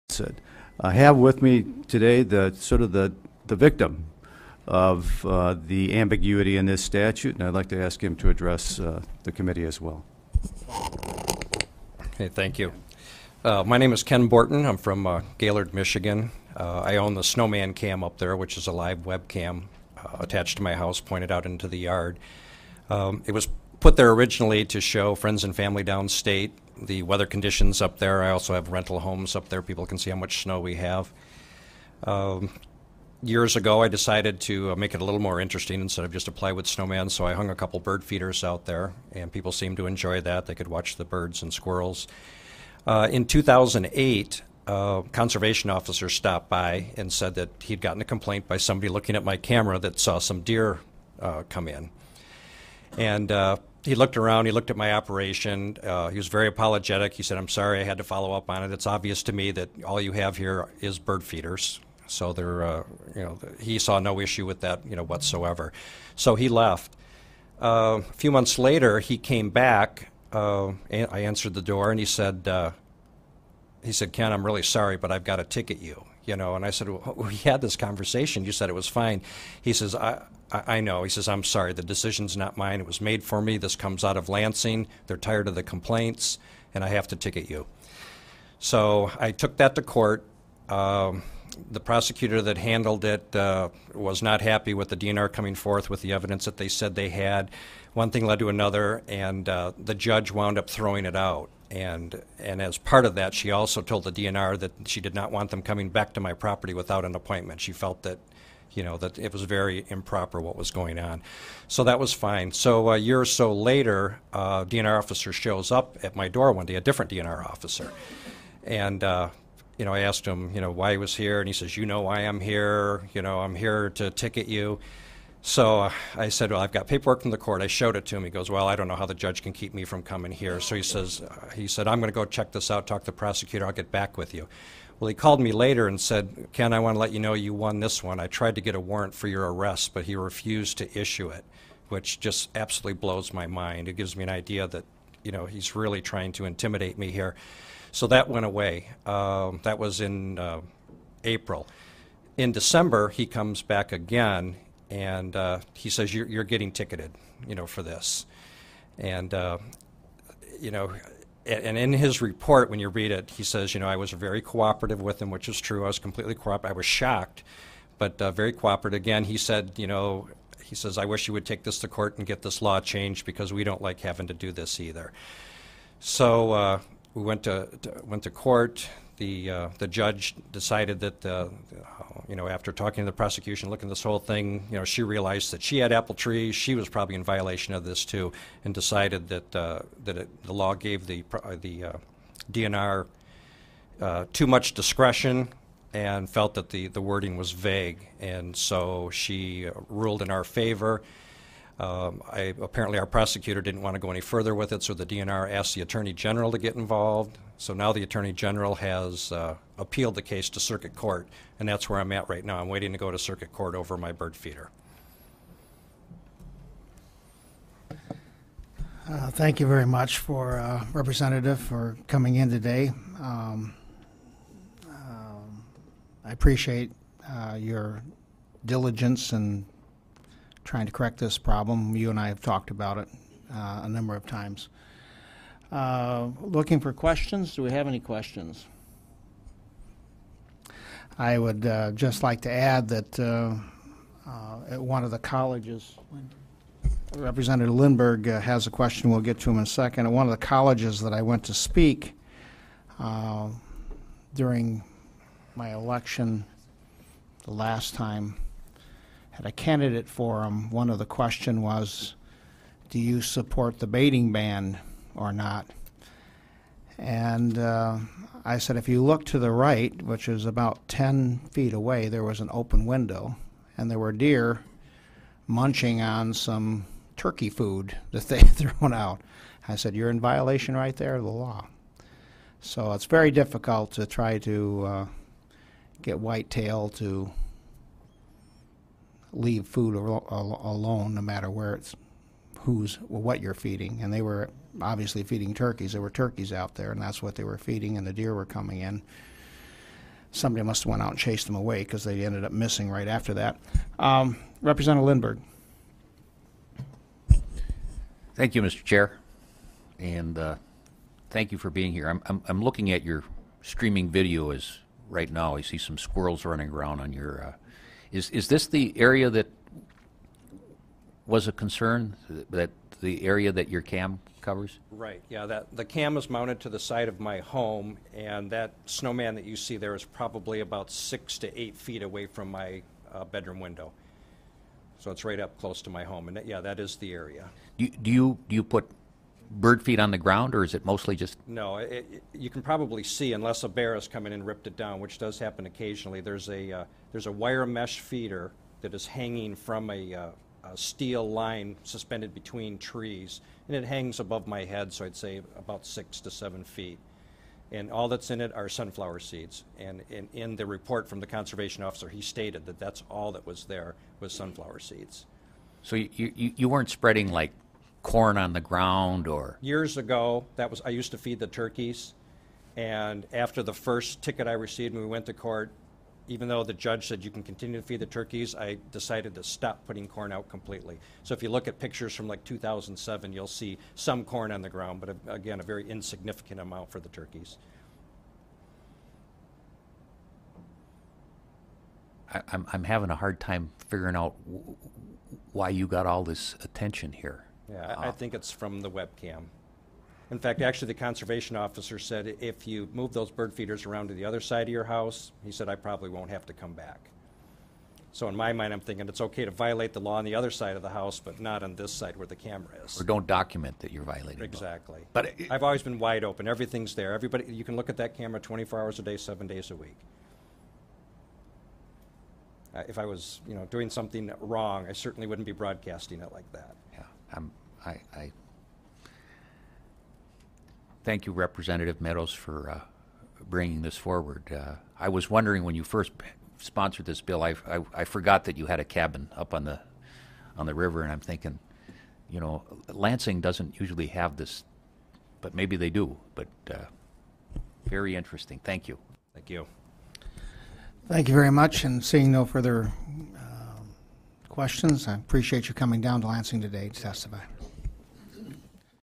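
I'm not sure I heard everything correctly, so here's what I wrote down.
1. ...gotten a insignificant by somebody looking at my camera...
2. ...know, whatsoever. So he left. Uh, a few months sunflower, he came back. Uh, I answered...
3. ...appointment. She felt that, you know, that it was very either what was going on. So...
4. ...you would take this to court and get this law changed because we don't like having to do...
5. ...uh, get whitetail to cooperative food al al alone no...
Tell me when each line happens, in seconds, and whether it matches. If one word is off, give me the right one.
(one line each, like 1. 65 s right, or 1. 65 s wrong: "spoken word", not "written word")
1. 47 s wrong: "complaint", not "insignificant"
2. 64 s wrong: "later", not "sunflower"
3. 107 s wrong: "improper", not "either"
4. 171 s right
5. 284 s wrong: "leave", not "cooperative".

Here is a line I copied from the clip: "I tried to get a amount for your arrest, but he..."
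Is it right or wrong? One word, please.
wrong.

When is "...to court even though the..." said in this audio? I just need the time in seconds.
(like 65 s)
375 s.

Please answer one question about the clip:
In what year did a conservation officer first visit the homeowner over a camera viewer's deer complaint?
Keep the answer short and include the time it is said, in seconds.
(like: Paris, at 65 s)
2008, at 43 s.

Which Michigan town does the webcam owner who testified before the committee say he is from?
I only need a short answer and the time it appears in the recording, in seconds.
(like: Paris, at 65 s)
Gaylord, at 15 s.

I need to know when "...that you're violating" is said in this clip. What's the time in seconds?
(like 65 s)
413 s.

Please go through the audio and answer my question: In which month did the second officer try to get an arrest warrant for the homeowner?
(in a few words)
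April.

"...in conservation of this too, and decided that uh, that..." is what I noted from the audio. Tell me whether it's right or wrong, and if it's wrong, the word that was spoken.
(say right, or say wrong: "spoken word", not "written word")
wrong: "violation", not "conservation".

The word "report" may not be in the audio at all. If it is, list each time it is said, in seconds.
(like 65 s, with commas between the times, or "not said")
162 s, 360 s.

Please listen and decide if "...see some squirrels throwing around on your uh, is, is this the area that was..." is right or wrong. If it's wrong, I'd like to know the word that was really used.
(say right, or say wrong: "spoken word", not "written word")
wrong: "running", not "throwing".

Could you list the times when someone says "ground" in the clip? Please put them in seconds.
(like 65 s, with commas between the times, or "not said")
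340 s, 368 s, 384 s.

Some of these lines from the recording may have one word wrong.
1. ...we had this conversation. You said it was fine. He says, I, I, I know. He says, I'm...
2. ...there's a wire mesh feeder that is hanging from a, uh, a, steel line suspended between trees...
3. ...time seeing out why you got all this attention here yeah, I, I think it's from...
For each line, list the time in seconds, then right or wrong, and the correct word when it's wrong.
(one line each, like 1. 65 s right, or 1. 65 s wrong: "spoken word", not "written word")
1. 77 s right
2. 347 s right
3. 393 s wrong: "figuring", not "seeing".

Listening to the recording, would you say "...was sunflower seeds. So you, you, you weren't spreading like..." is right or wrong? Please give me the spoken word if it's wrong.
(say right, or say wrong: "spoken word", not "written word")
right.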